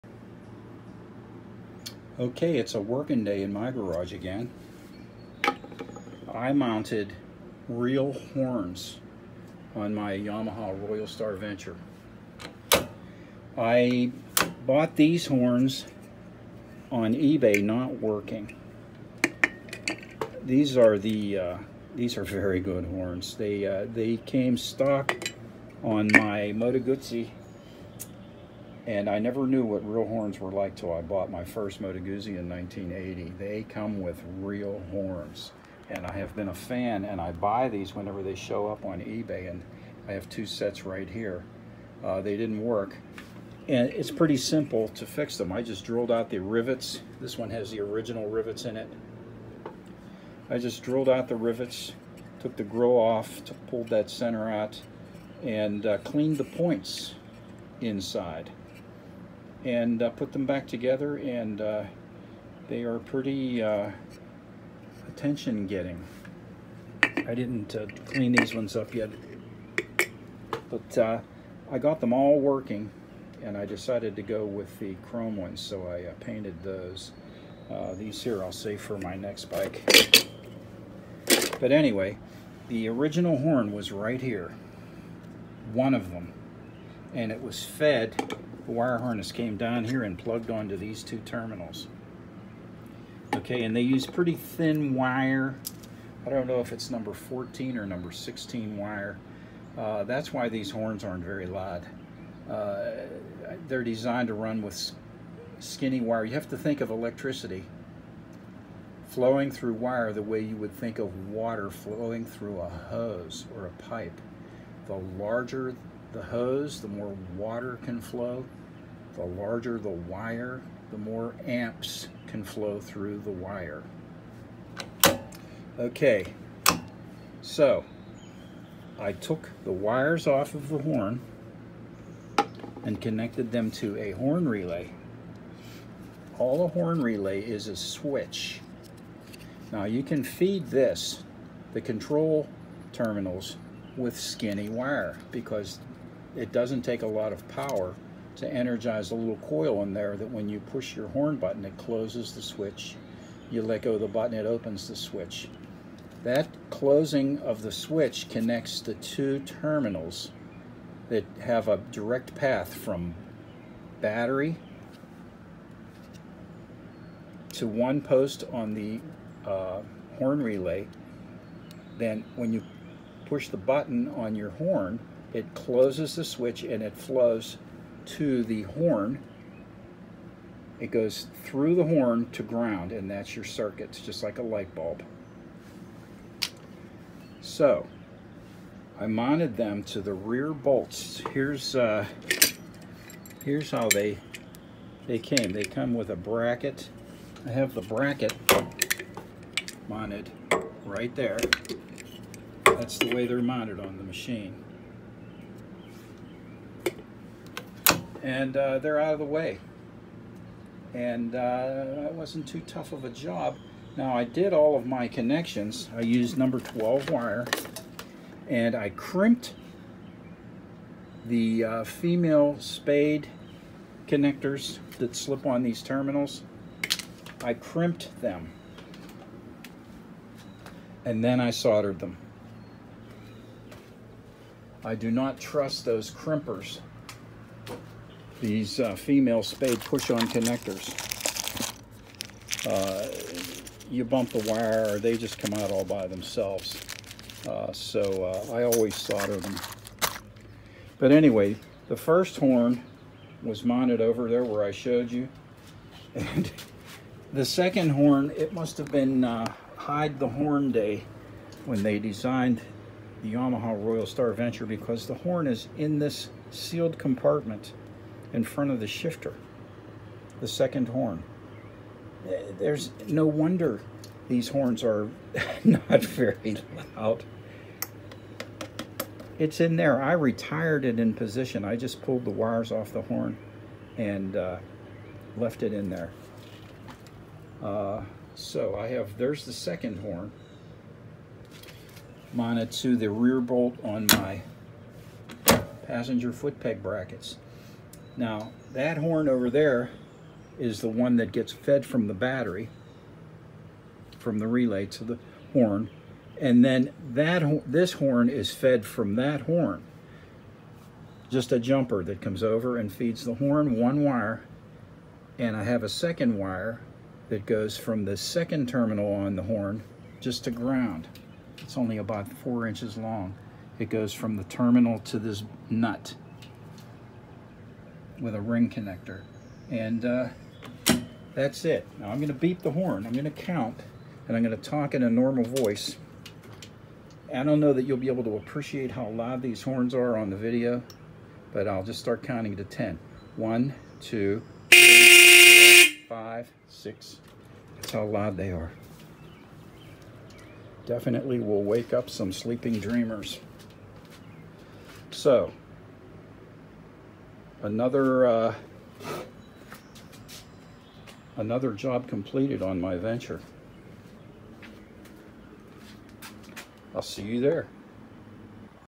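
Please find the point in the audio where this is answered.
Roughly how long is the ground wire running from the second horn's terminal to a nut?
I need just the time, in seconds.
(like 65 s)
321 s.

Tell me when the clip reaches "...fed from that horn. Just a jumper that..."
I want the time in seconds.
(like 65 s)
308 s.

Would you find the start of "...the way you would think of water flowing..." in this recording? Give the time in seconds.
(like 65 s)
110 s.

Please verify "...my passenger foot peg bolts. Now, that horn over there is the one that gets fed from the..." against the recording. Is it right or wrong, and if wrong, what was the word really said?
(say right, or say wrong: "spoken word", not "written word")
wrong: "brackets", not "bolts".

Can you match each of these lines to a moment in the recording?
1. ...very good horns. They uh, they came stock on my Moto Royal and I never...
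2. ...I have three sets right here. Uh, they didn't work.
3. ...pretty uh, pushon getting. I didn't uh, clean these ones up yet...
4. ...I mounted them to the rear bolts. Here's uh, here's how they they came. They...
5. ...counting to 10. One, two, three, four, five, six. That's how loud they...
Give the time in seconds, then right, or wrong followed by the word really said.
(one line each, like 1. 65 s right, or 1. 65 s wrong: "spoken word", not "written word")
1. 22 s wrong: "Guzzi", not "Royal"
2. 40 s wrong: "two", not "three"
3. 62 s wrong: "attention", not "pushon"
4. 188 s right
5. 342 s right.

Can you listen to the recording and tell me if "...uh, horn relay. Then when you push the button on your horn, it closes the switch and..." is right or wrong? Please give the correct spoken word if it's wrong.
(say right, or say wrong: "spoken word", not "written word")
right.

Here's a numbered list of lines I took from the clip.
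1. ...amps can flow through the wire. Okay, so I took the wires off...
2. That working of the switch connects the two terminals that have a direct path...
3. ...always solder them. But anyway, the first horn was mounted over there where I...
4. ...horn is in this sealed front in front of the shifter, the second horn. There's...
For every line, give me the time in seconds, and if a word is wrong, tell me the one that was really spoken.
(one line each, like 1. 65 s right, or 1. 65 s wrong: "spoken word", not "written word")
1. 121 s right
2. 156 s wrong: "closing", not "working"
3. 248 s right
4. 265 s wrong: "compartment", not "front".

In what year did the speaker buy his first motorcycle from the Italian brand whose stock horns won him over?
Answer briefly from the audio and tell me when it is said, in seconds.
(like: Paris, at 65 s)
1980, at 32 s.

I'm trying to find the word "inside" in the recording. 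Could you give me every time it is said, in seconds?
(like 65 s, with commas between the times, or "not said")
57 s.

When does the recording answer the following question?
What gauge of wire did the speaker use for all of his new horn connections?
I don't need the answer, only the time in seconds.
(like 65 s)
216 s.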